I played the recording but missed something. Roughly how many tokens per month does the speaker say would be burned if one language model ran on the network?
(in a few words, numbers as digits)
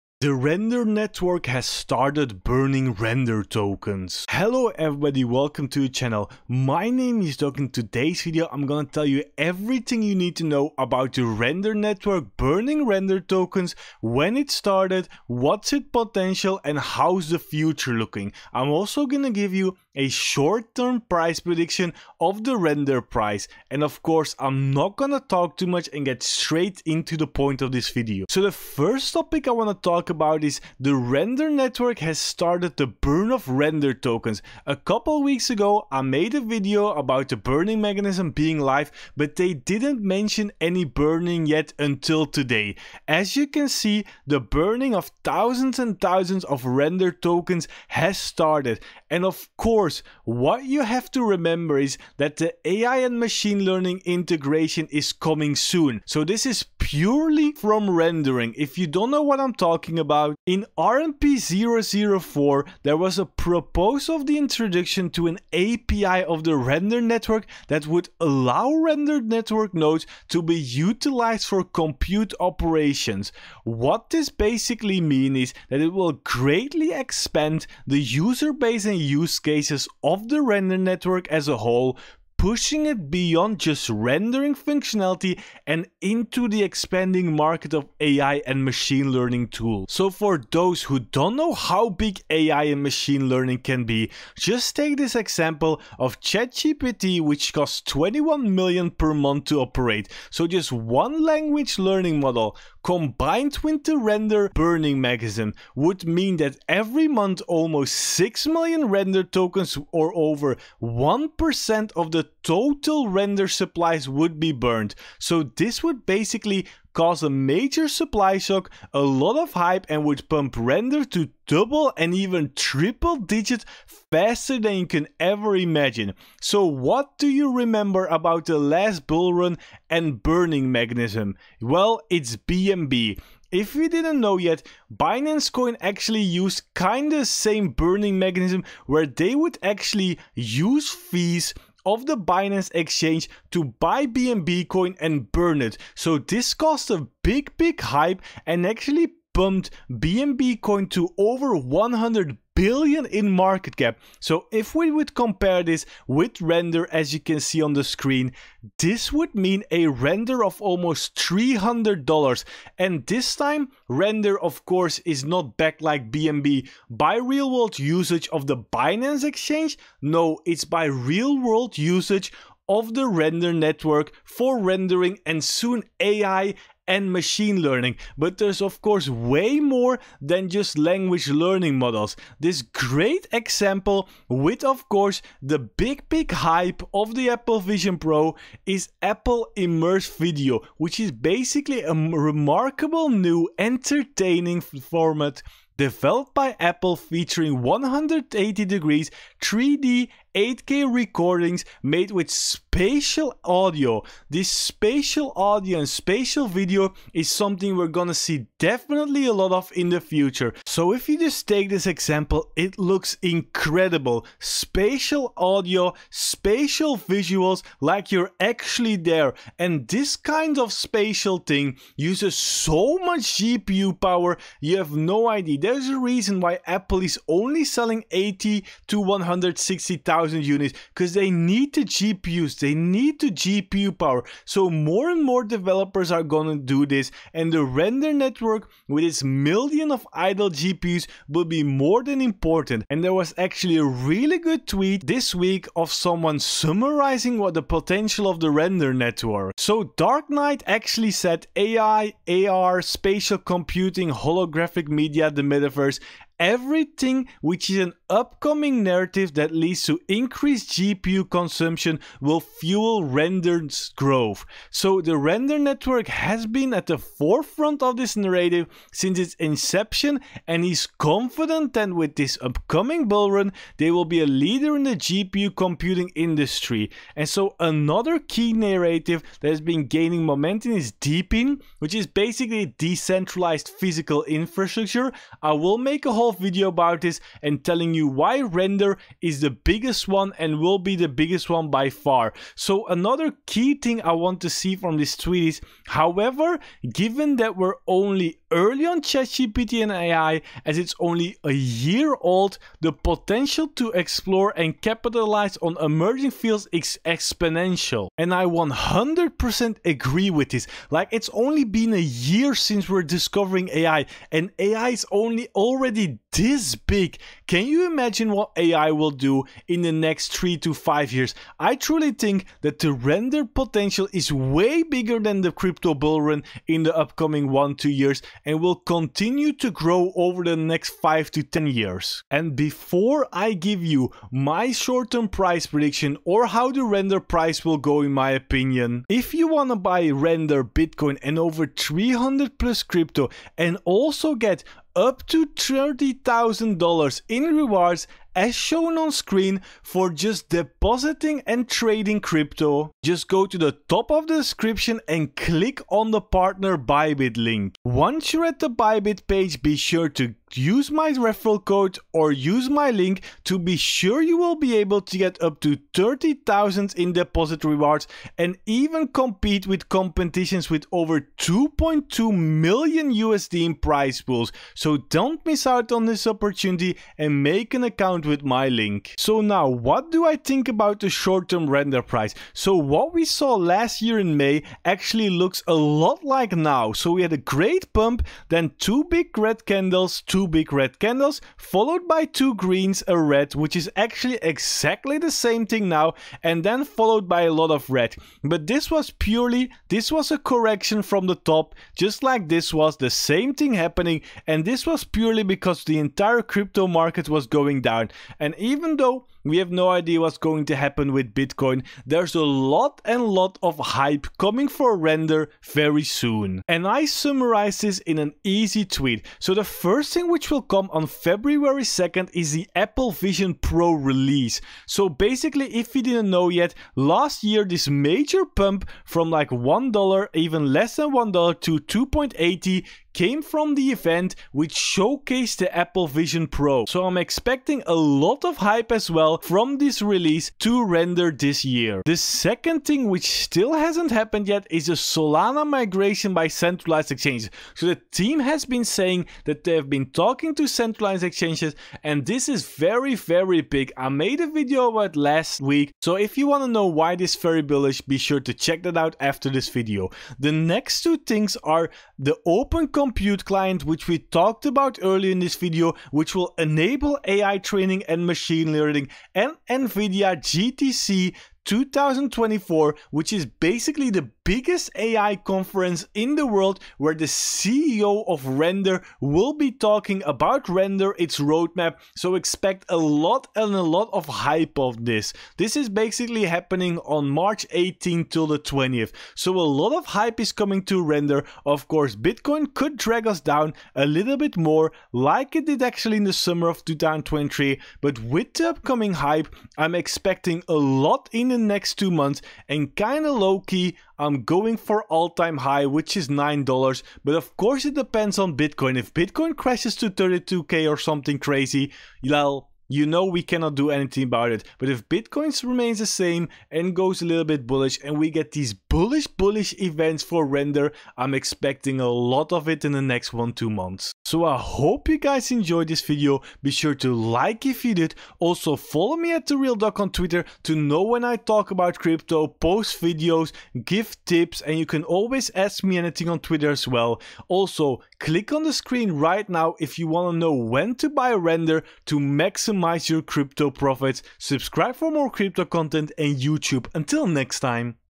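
6 million.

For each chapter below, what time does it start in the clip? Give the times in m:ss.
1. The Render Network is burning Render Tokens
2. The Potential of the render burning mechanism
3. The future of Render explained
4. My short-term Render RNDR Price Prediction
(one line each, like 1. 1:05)
1. 0:28
2. 1:30
3. 4:06
4. 6:19.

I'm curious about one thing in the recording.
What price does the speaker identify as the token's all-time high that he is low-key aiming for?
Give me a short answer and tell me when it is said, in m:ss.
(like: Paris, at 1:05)
$9, at 8:26.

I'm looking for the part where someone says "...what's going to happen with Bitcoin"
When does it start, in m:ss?
6:50.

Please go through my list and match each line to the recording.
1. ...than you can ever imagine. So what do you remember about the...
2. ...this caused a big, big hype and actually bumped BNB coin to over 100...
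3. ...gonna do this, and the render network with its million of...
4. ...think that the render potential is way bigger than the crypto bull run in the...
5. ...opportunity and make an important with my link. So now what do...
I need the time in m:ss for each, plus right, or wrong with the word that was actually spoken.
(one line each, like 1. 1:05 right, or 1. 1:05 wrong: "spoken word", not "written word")
1. 2:04 right
2. 2:26 right
3. 3:56 right
4. 5:22 right
5. 6:16 wrong: "account", not "important".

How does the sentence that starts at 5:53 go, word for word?
Just go to the top of the description and click on the partner Bybit link.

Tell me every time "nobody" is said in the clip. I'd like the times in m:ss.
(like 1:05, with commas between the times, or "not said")
not said.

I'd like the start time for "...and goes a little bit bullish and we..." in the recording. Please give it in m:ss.
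8:36.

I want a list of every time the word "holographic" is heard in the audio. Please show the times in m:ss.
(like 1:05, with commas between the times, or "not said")
4:14.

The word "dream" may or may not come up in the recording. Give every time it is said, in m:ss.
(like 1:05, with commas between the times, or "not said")
not said.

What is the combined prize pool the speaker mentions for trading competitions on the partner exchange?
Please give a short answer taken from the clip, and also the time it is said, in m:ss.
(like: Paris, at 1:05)
2.2 million USD, at 6:11.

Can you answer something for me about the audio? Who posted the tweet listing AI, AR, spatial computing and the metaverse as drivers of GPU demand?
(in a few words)
Dark Knight.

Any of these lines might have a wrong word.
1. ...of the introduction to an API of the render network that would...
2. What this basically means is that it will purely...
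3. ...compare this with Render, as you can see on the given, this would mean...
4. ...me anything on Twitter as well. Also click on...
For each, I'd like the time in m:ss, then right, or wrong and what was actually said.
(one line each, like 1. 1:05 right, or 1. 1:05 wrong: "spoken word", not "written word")
1. 1:04 right
2. 1:13 wrong: "greatly", not "purely"
3. 2:35 wrong: "screen", not "given"
4. 8:55 right.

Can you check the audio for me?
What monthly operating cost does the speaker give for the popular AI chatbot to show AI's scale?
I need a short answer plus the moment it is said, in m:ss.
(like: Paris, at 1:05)
21 million, at 1:37.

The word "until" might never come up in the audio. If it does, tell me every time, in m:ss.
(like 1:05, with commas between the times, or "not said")
0:41, 9:06.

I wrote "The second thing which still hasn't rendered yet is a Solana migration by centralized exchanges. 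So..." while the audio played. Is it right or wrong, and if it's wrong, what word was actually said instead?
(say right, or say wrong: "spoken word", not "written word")
wrong: "happened", not "rendered".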